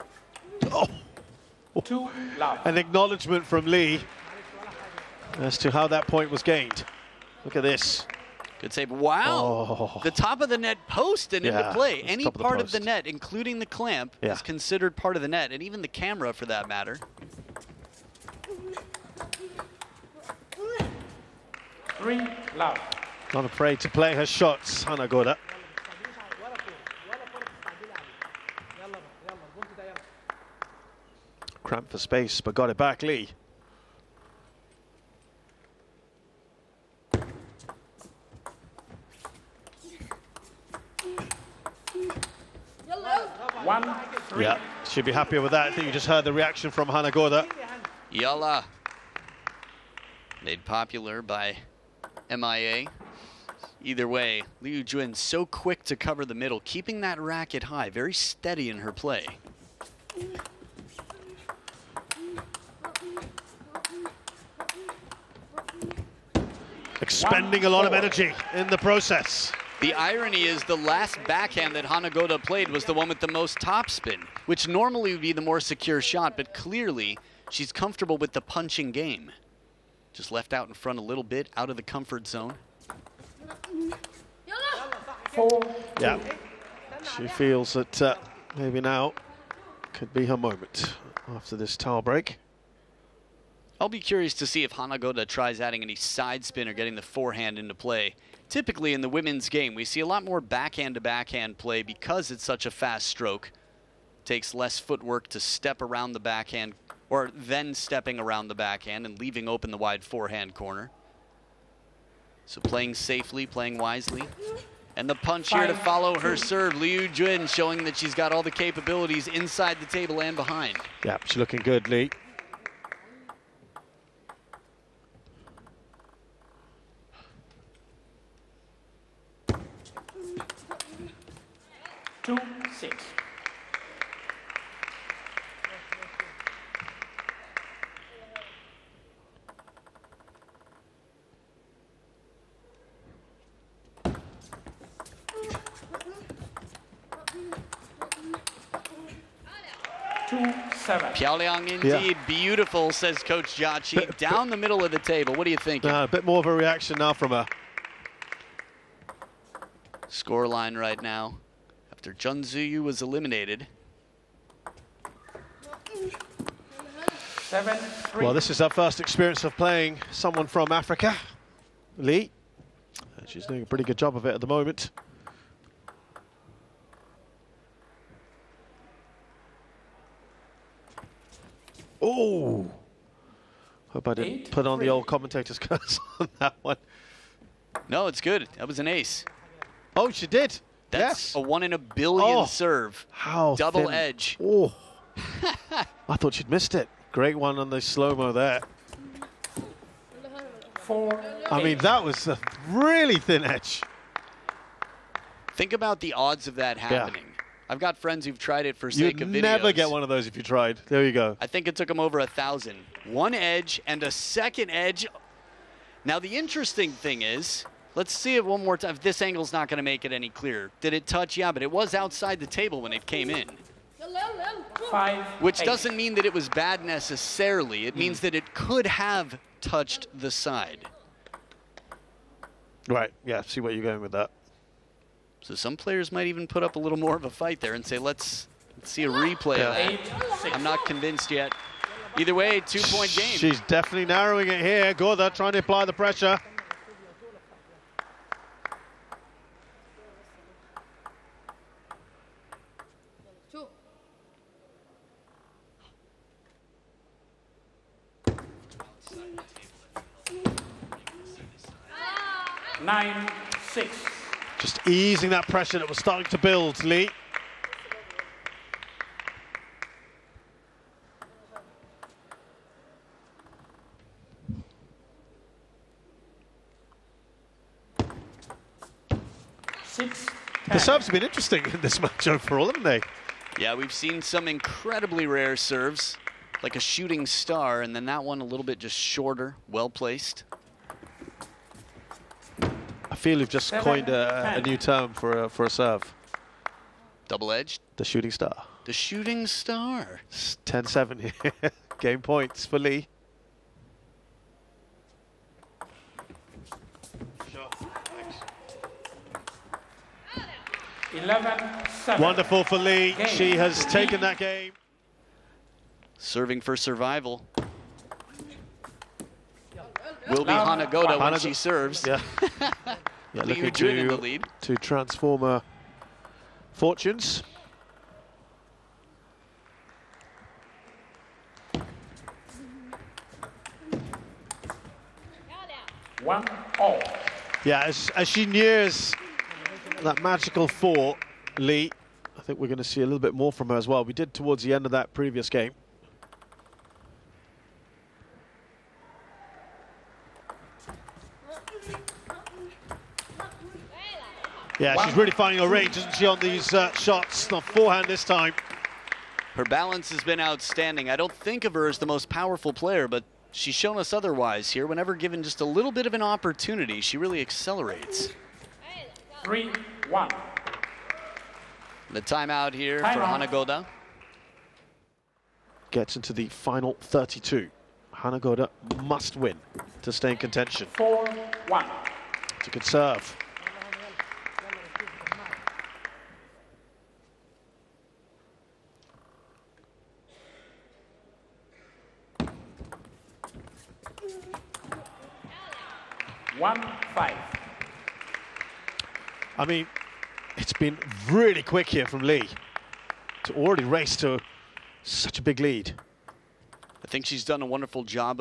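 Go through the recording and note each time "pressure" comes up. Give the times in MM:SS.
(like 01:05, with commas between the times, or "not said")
04:05, 04:25.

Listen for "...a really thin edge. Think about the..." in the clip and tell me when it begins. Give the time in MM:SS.
03:22.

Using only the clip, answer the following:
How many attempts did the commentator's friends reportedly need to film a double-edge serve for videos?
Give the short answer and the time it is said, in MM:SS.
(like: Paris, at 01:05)
over a thousand, at 03:31.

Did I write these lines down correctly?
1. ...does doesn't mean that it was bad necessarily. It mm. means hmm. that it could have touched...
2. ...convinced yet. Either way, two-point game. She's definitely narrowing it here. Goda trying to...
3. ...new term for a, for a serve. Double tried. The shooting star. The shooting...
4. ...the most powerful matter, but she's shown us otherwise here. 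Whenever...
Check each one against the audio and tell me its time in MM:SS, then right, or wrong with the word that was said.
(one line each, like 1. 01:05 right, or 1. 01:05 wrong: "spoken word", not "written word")
1. 03:45 right
2. 04:00 right
3. 04:54 wrong: "edged", not "tried"
4. 06:01 wrong: "player", not "matter".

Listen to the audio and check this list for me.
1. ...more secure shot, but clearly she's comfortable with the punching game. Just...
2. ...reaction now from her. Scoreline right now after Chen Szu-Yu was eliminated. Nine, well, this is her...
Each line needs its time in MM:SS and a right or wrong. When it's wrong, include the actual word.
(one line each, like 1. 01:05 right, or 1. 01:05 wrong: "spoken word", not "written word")
1. 01:15 right
2. 02:36 wrong: "Seven", not "Nine".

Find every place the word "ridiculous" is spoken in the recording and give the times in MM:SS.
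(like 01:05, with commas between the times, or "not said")
not said.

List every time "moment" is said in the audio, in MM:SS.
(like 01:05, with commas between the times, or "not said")
01:30, 02:54.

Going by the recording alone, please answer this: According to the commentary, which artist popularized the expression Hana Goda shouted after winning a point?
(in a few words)
MIA.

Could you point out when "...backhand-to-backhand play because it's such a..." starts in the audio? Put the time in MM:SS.
01:40.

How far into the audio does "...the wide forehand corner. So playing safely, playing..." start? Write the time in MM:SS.
01:49.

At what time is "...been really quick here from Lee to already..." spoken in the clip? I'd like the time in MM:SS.
06:40.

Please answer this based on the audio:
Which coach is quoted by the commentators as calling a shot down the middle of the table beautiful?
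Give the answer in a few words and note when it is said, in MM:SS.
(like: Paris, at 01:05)
Coach Jachi, at 02:33.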